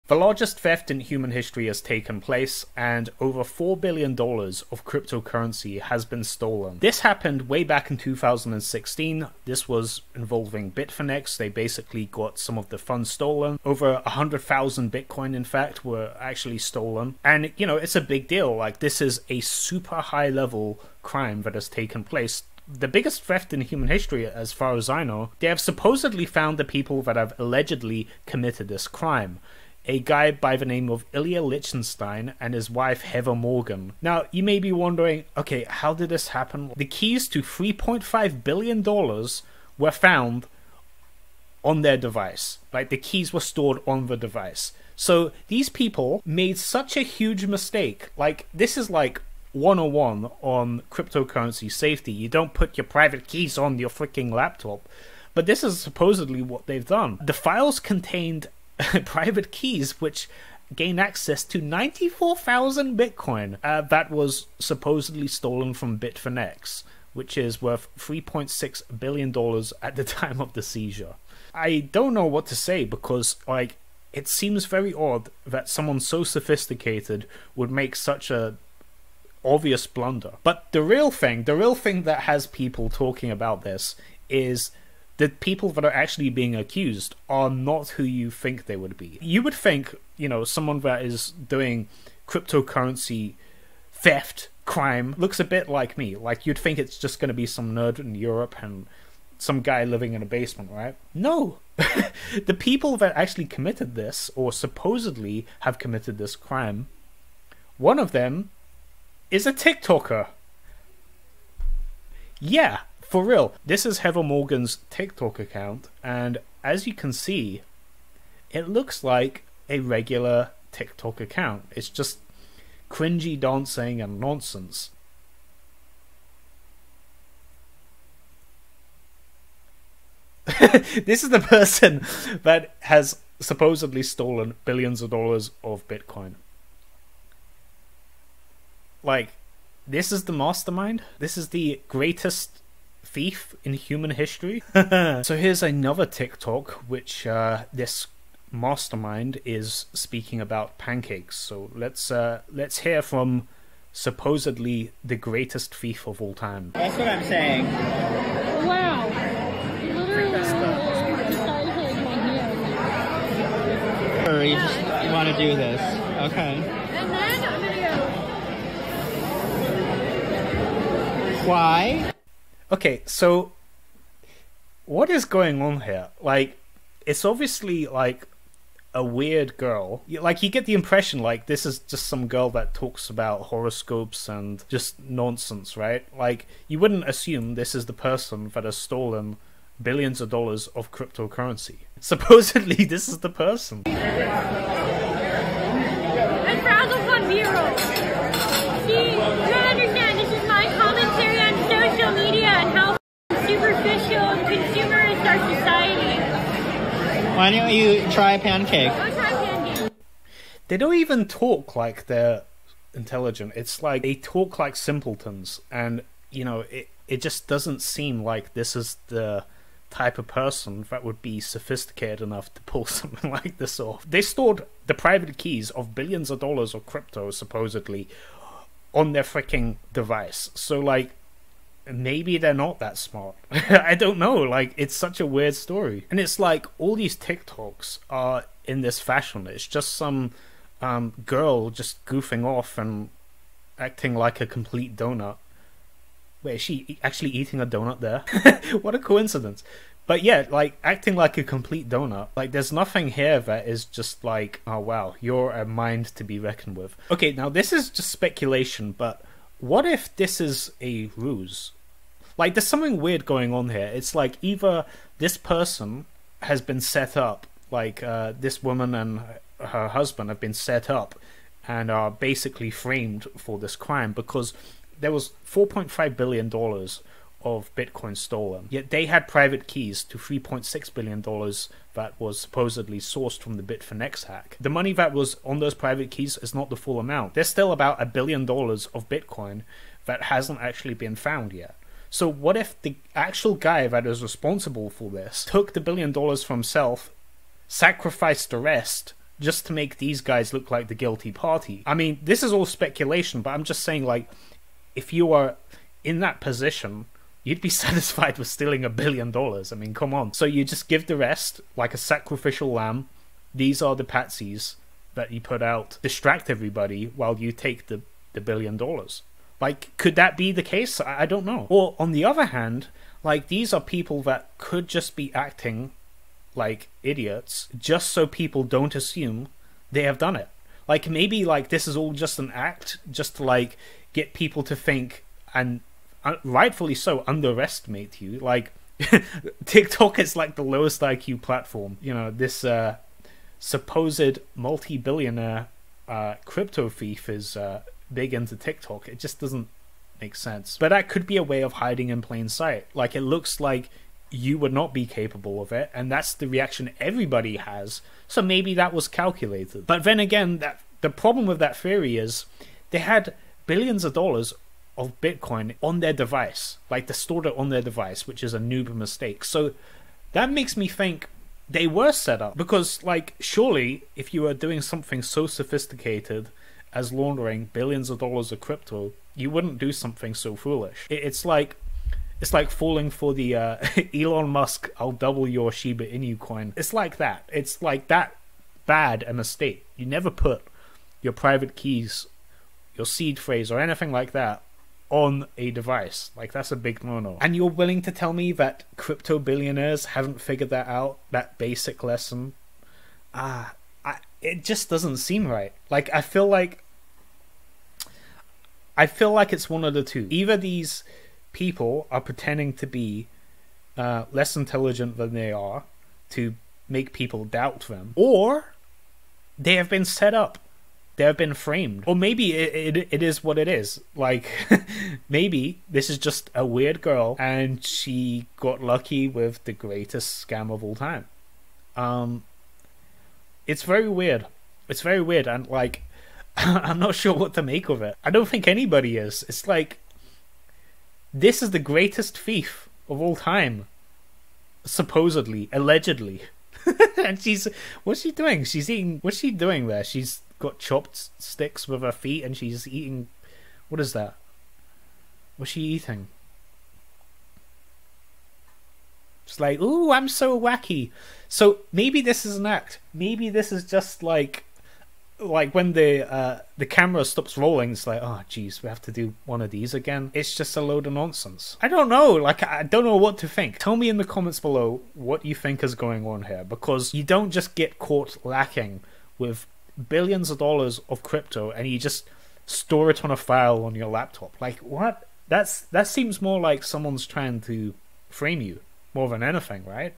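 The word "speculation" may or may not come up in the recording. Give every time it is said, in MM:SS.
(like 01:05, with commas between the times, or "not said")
04:18, 05:02.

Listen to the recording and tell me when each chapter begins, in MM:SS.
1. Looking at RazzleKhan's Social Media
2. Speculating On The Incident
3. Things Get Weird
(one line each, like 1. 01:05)
1. 01:47
2. 04:18
3. 00:34.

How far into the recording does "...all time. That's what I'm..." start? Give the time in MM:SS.
02:36.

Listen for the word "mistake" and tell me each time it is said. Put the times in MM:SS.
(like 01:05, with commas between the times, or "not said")
00:47, 06:08, 06:29.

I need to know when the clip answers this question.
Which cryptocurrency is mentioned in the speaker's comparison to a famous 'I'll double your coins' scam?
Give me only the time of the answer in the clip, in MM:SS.
06:25.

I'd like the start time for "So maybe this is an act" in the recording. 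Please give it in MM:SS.
07:41.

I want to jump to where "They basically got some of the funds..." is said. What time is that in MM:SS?
00:11.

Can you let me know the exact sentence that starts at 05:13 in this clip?
These are the patsies that you put out.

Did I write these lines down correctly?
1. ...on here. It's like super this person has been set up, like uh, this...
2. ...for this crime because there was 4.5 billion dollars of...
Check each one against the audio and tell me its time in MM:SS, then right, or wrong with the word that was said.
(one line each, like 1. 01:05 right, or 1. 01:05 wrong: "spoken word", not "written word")
1. 04:23 wrong: "either", not "super"
2. 04:33 right.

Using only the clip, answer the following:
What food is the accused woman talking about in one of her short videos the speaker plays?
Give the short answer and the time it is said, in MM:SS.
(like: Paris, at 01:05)
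Pancakes, at 02:30.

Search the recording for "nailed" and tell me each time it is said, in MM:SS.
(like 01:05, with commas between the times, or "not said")
not said.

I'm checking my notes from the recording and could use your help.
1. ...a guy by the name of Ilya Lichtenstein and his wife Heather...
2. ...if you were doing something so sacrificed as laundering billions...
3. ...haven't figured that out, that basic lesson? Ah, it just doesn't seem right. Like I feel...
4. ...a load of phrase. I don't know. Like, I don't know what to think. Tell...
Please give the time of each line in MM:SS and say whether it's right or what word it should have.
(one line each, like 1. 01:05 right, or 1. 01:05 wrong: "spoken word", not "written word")
1. 00:29 right
2. 06:14 wrong: "sophisticated", not "sacrificed"
3. 06:40 right
4. 07:50 wrong: "nonsense", not "phrase".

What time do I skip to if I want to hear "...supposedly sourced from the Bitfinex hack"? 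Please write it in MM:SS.
04:42.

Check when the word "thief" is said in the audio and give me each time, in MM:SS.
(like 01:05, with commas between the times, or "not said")
02:23, 02:35, 05:46, 07:22.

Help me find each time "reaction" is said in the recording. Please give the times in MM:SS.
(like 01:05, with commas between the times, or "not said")
05:56.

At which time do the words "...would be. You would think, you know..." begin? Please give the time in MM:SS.
01:28.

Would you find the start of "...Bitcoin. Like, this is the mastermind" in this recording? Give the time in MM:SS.
02:15.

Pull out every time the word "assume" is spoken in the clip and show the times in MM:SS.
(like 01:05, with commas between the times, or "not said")
03:07, 05:28.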